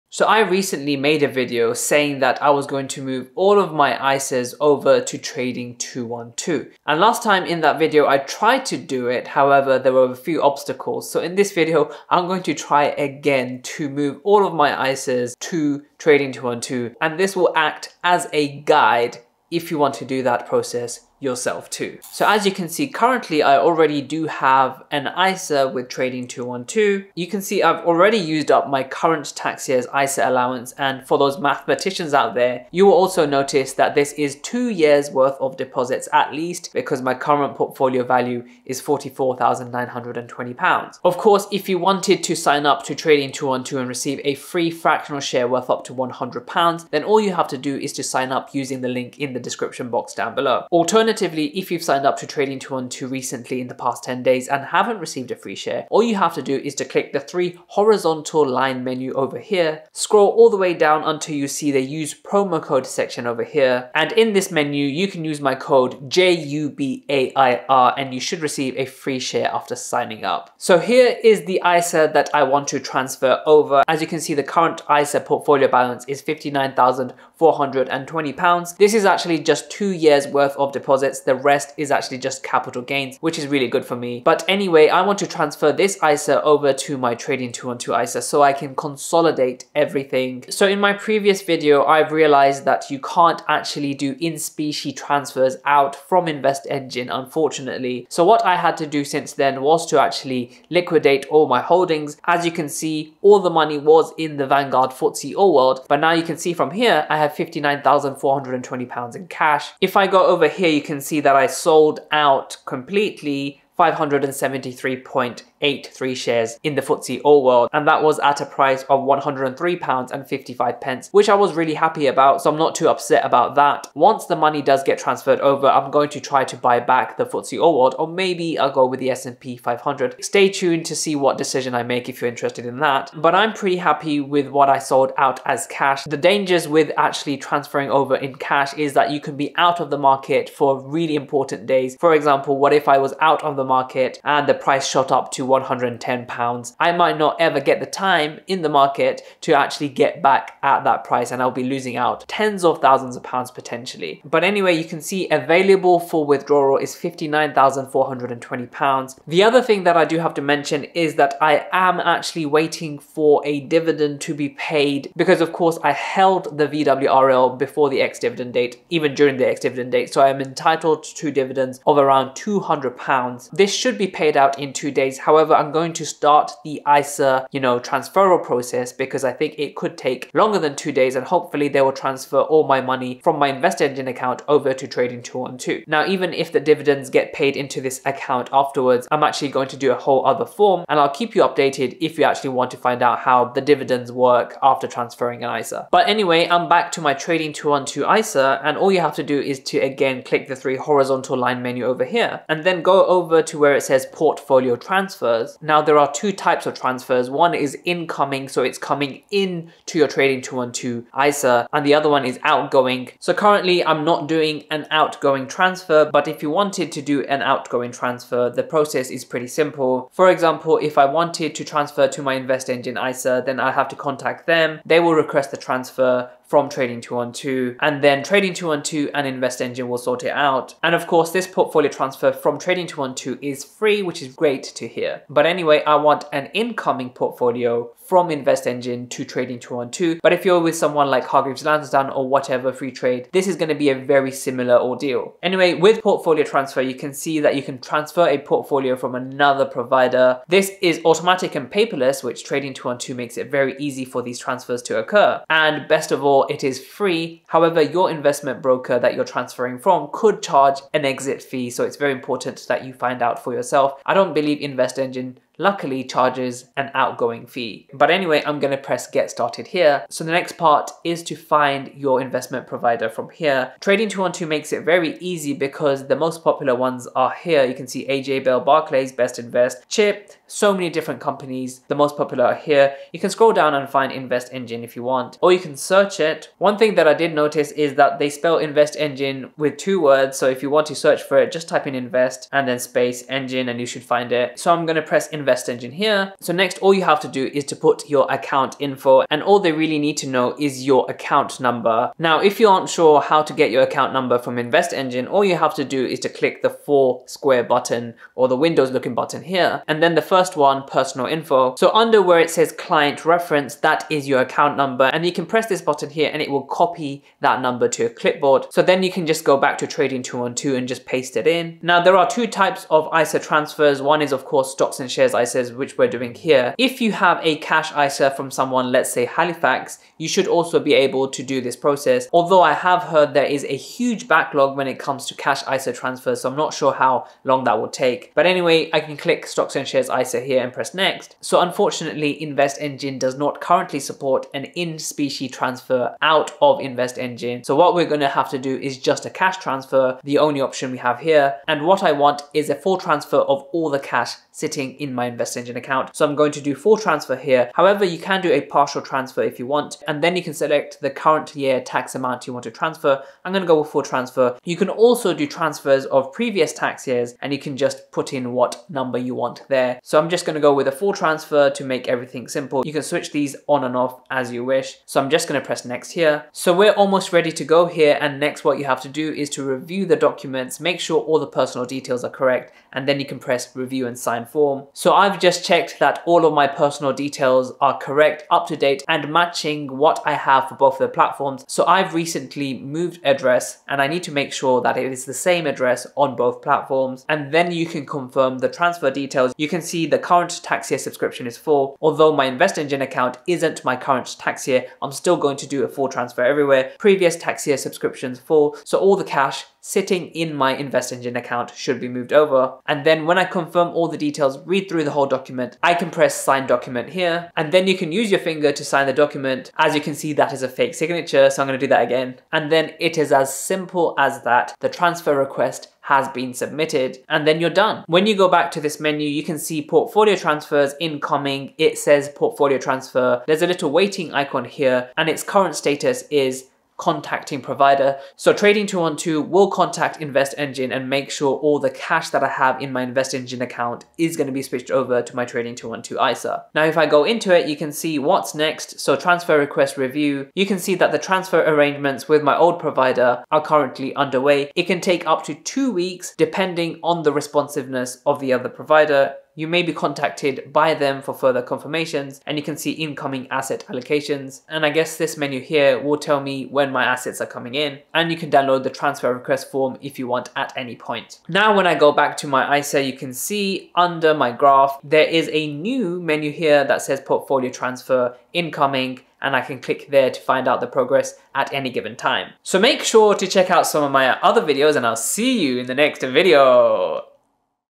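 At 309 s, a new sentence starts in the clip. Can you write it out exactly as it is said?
And then the first one, personal info.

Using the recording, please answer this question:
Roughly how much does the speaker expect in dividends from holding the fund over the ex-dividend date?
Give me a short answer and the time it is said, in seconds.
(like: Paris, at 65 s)
200 pounds, at 172 s.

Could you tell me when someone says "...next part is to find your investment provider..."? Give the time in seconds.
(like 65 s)
270 s.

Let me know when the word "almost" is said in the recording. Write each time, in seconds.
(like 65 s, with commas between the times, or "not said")
377 s.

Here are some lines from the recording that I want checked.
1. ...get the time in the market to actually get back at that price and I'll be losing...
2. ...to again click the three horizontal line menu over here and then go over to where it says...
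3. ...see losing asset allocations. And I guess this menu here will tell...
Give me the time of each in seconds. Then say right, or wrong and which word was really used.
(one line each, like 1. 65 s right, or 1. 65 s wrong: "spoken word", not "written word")
1. 147 s right
2. 199 s right
3. 462 s wrong: "incoming", not "losing".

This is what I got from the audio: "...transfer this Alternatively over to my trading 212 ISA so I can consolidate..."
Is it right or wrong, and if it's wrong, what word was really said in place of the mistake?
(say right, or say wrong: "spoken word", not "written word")
wrong: "ISA", not "Alternatively".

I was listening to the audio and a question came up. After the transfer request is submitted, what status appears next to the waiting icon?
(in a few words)
Contacting provider.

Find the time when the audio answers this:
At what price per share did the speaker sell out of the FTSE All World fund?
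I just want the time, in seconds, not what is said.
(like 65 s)
119 s.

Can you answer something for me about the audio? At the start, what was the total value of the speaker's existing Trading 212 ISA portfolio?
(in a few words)
£44,920.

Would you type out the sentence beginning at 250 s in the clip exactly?
This is automatic and paperless, which Trading 212 makes it very easy for these transfers to occur.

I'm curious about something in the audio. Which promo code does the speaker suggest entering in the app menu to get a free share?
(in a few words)
JUBAIR.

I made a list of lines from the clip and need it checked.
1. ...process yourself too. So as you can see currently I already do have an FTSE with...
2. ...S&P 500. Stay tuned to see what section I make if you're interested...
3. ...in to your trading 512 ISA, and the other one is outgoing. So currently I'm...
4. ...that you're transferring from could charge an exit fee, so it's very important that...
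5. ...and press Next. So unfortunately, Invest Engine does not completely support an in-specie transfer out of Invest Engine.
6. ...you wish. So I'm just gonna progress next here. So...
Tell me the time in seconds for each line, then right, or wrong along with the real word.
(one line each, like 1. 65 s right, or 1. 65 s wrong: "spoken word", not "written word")
1. 20 s wrong: "ISA", not "FTSE"
2. 129 s wrong: "decision", not "section"
3. 209 s wrong: "212", not "512"
4. 258 s right
5. 340 s wrong: "currently", not "completely"
6. 374 s wrong: "press", not "progress".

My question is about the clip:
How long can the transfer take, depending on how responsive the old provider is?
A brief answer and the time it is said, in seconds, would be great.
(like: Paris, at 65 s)
Two weeks, at 455 s.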